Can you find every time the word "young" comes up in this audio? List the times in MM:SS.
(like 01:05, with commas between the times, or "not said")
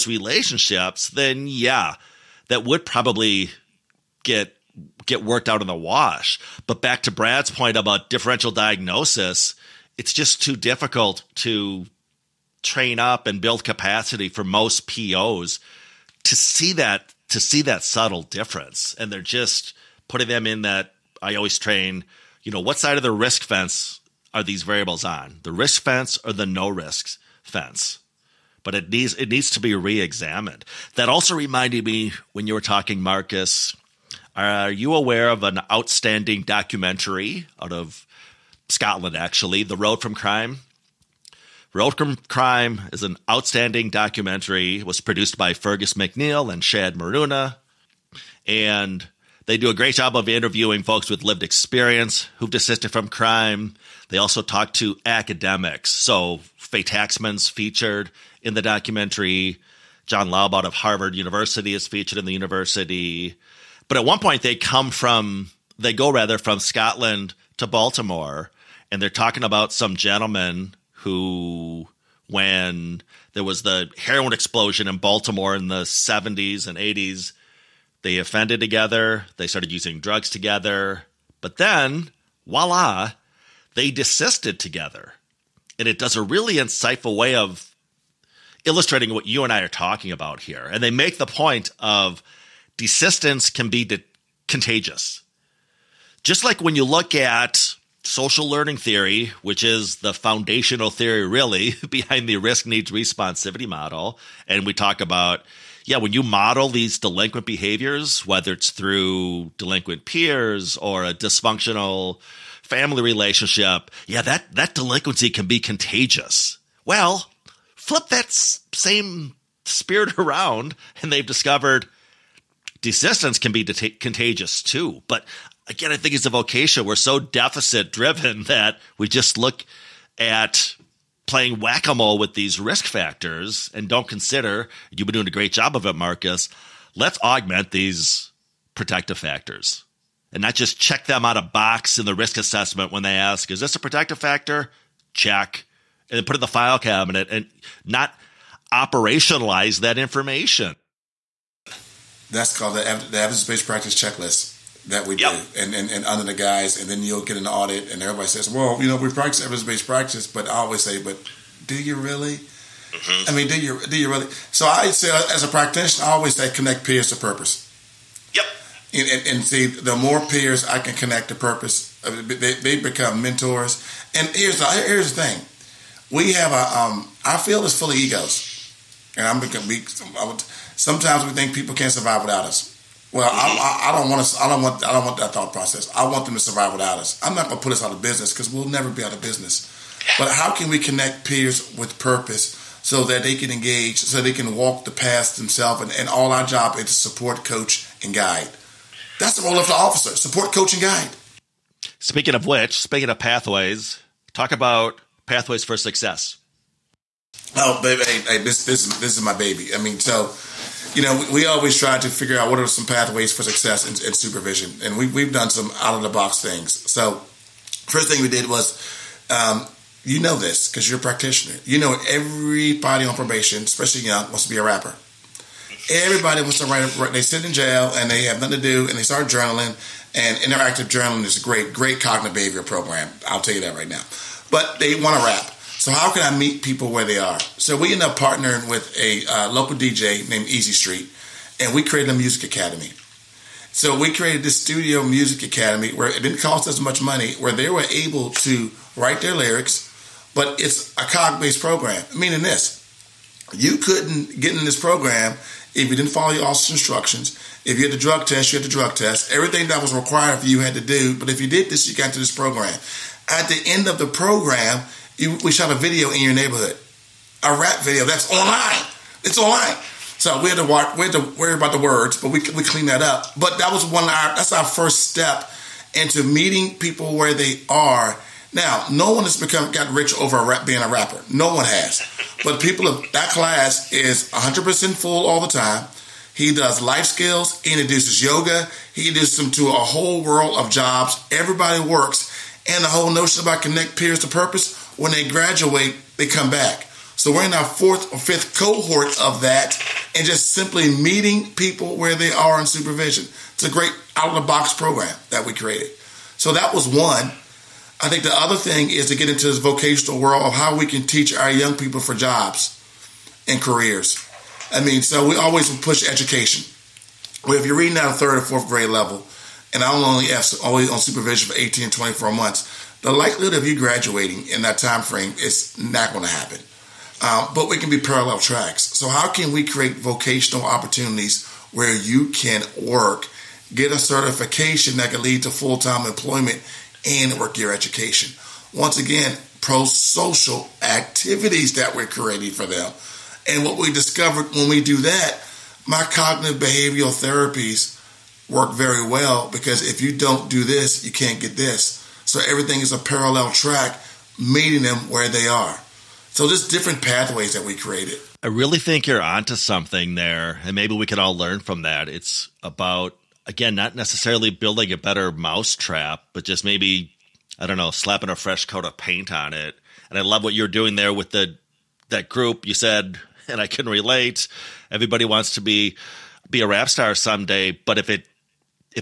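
03:44, 05:11.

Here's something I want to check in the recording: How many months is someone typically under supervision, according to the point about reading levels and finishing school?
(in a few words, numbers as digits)
18 to 24 months.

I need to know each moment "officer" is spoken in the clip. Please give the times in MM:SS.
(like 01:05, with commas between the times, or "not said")
03:19, 04:16.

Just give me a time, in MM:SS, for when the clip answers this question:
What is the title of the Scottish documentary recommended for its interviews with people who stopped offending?
00:39.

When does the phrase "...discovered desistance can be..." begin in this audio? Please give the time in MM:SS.
02:01.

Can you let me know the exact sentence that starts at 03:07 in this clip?
I'm not going to put us out of business because we'll never be out of business.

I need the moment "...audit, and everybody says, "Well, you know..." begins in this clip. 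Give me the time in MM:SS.
02:37.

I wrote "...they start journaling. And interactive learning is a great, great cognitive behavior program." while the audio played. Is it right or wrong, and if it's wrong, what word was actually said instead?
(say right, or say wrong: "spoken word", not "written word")
wrong: "journaling", not "learning".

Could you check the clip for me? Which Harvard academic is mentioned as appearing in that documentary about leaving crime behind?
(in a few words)
John Laub.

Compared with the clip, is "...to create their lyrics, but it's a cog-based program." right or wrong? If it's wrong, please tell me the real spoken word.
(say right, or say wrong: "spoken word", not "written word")
wrong: "write", not "create".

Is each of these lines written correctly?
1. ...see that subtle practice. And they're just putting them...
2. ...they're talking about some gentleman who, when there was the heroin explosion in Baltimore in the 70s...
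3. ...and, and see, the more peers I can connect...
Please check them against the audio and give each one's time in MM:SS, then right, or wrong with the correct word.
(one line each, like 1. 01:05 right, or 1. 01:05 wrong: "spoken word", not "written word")
1. 00:17 wrong: "difference", not "practice"
2. 01:09 right
3. 02:49 right.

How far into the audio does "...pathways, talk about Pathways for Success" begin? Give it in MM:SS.
03:23.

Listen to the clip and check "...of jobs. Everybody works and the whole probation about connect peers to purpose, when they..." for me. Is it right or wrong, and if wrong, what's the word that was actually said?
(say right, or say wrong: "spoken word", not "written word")
wrong: "notion", not "probation".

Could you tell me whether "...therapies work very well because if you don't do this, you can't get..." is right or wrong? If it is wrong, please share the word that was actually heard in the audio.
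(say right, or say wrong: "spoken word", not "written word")
right.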